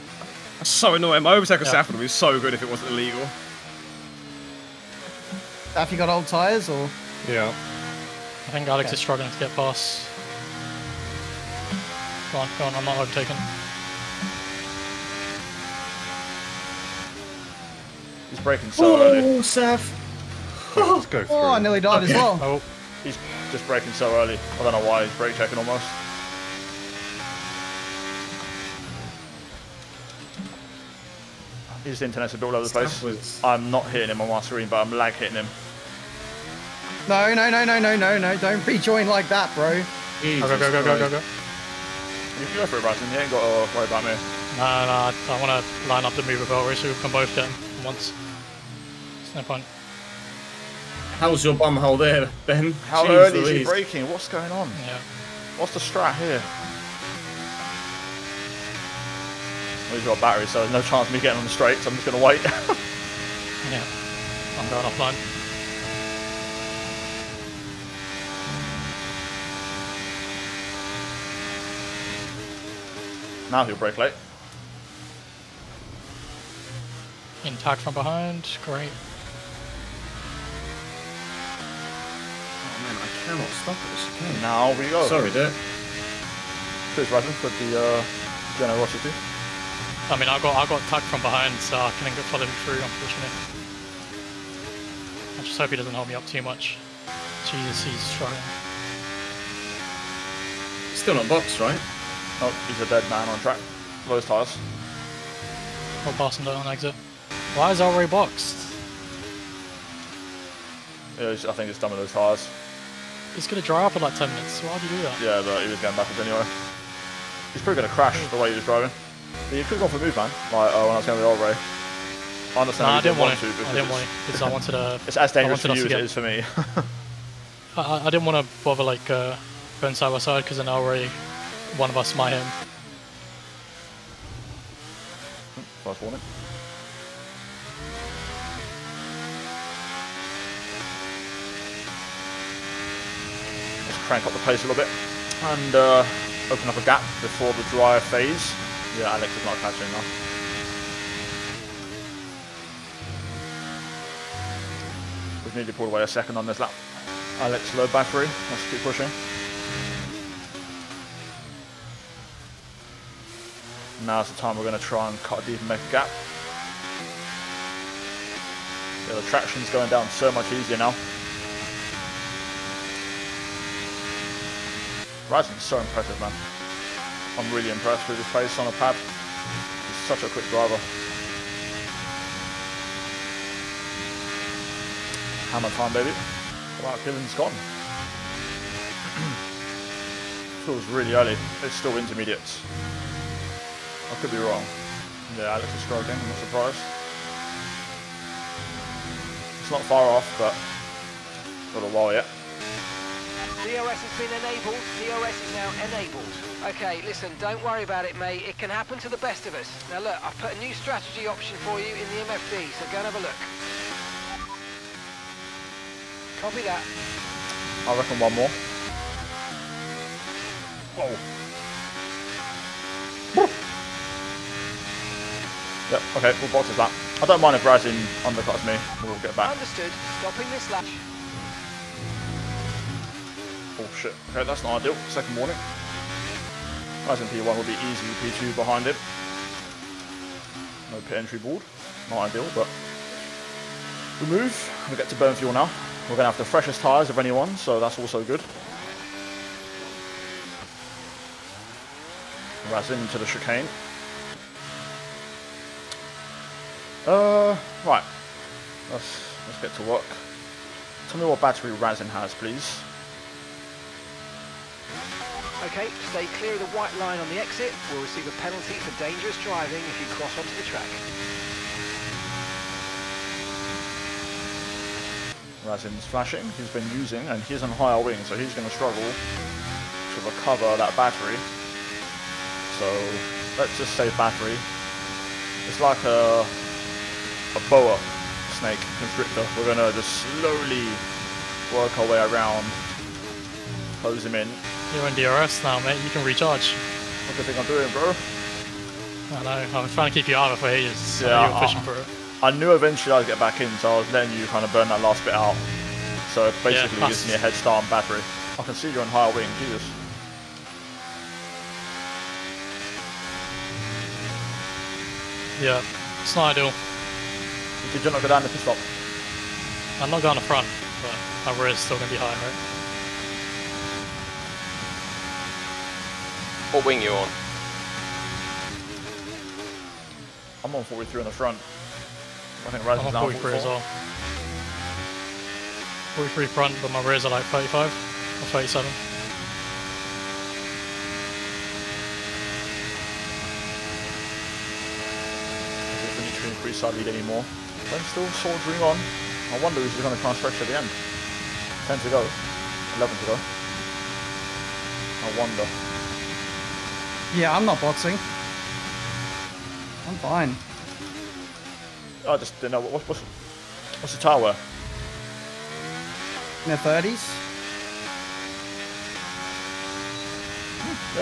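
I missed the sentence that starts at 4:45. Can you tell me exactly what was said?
It's like a, a boa snake constrictor.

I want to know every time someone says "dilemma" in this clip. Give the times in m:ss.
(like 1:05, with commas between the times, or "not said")
not said.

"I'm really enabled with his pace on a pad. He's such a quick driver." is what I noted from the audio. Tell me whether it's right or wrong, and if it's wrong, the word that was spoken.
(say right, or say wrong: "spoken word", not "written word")
wrong: "impressed", not "enabled".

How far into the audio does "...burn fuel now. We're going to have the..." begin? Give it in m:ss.
4:05.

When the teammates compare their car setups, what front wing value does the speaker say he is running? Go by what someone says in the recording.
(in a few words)
43.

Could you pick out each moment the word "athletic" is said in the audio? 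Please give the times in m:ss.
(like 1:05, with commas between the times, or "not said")
not said.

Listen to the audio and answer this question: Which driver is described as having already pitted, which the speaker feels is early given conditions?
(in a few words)
Kevin.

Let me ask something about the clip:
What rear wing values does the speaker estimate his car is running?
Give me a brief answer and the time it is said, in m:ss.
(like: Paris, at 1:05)
35 or 37, at 5:37.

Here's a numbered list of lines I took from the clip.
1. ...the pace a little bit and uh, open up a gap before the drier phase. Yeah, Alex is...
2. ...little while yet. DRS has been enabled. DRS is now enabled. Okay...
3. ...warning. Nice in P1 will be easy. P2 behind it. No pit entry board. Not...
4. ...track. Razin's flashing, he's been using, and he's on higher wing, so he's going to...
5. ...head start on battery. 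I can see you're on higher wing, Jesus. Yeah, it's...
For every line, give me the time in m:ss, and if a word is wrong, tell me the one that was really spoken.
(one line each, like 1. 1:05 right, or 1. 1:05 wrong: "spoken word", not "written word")
1. 2:24 right
2. 3:21 right
3. 3:55 right
4. 4:30 right
5. 5:07 right.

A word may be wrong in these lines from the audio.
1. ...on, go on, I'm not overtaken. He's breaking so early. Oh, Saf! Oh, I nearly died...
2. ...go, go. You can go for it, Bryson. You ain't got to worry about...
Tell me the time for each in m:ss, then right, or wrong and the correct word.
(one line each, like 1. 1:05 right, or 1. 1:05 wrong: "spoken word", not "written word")
1. 0:12 right
2. 0:40 right.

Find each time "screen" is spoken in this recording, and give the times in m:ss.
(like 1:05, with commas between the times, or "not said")
0:34.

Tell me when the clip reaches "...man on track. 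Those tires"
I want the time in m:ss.
1:43.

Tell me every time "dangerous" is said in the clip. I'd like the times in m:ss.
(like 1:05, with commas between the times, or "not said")
2:05, 4:28.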